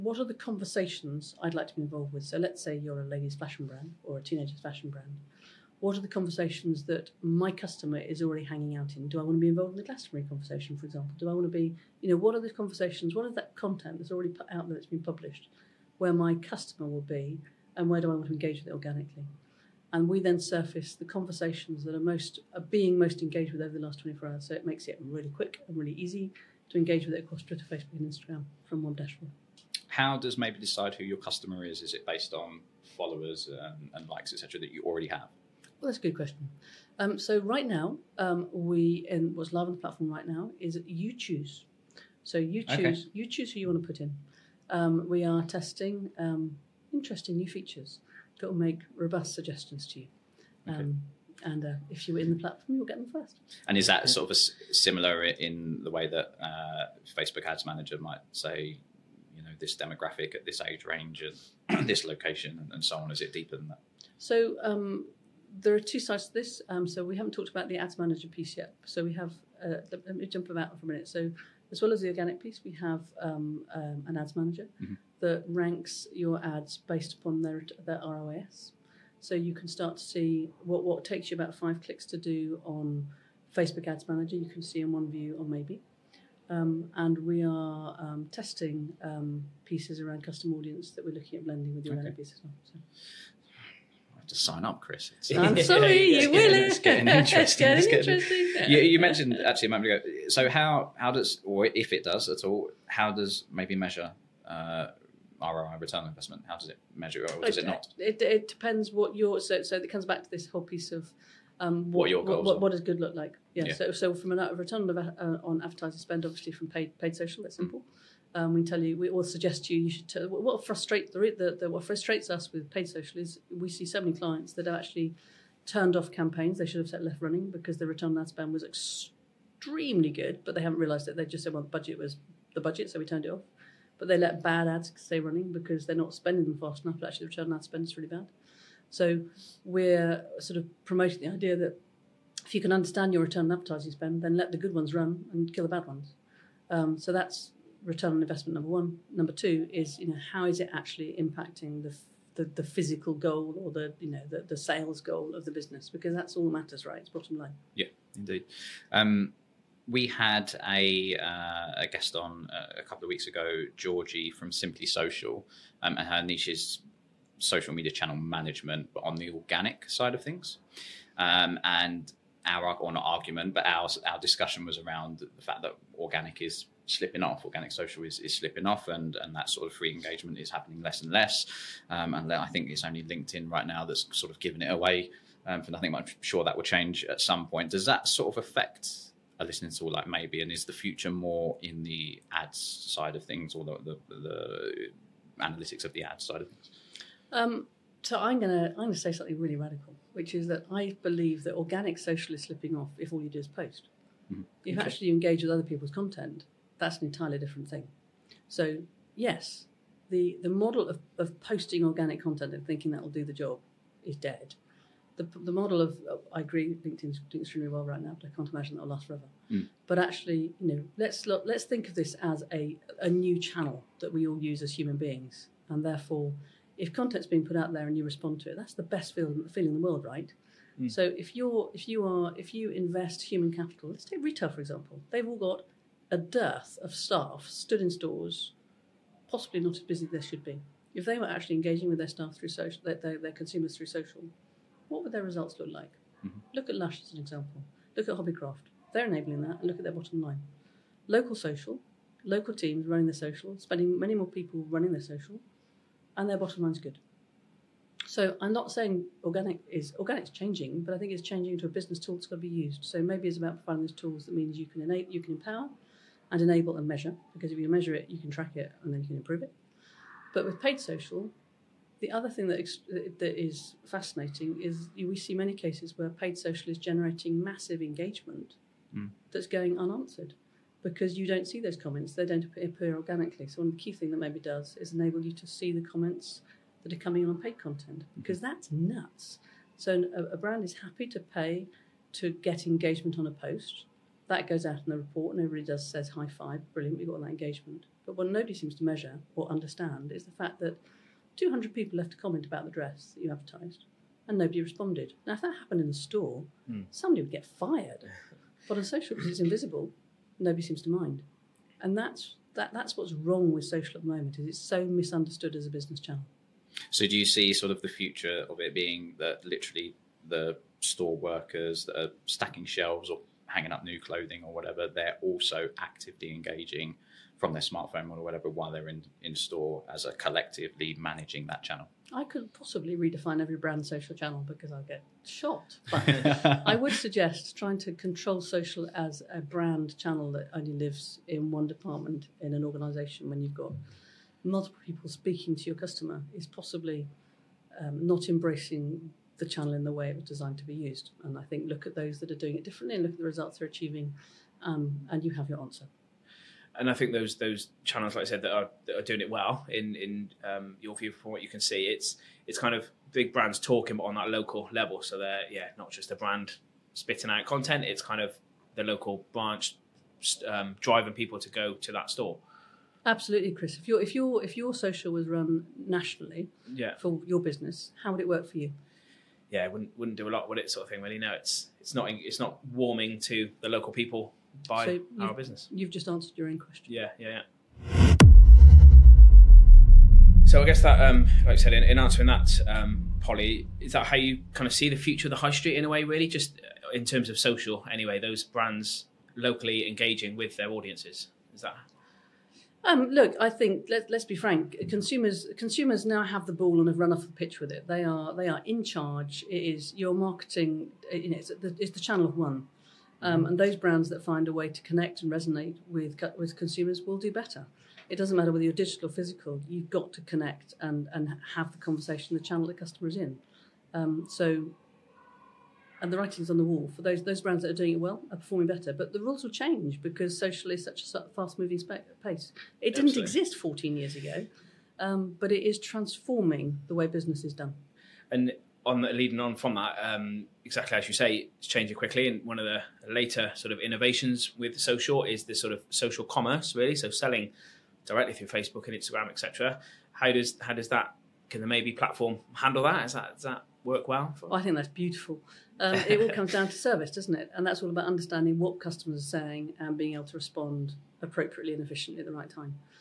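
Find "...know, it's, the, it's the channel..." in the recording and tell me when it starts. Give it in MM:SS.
06:51.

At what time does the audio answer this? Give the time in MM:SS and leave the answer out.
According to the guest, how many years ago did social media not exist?
07:13.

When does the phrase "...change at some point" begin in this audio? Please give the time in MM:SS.
03:06.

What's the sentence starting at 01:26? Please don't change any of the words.
Um, and we are um, testing um, pieces around custom audience that we're looking at blending with the okay.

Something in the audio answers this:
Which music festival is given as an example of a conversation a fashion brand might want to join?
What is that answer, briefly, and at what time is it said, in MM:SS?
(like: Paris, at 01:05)
Glastonbury, at 00:09.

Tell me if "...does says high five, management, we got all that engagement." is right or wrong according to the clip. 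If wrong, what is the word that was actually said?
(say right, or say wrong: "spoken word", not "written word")
wrong: "brilliant", not "management".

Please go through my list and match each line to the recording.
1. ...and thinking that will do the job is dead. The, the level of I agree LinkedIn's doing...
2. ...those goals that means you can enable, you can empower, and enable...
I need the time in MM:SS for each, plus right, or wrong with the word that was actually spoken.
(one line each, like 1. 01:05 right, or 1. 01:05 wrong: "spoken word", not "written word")
1. 03:32 wrong: "model", not "level"
2. 04:23 wrong: "tools", not "goals".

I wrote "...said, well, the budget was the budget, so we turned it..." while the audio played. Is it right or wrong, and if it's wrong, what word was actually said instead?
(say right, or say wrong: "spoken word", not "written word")
right.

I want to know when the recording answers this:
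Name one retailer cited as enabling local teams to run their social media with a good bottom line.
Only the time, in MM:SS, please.
04:06.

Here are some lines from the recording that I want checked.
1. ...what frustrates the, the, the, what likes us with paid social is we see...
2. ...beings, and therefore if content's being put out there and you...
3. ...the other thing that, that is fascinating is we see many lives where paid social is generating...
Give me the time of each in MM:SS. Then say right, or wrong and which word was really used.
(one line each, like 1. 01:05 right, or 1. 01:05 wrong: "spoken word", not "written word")
1. 02:00 wrong: "frustrates", not "likes"
2. 03:44 right
3. 04:31 wrong: "cases", not "lives".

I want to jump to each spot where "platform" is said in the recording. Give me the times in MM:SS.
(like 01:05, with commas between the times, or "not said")
00:39, 00:52, 07:31.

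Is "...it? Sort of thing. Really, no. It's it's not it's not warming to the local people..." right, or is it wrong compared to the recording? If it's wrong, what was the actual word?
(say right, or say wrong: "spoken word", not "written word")
right.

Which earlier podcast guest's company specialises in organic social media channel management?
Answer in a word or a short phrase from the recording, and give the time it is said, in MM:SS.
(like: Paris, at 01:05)
Simply Social, at 02:44.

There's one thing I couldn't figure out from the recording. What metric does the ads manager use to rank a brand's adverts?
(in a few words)
ROAS.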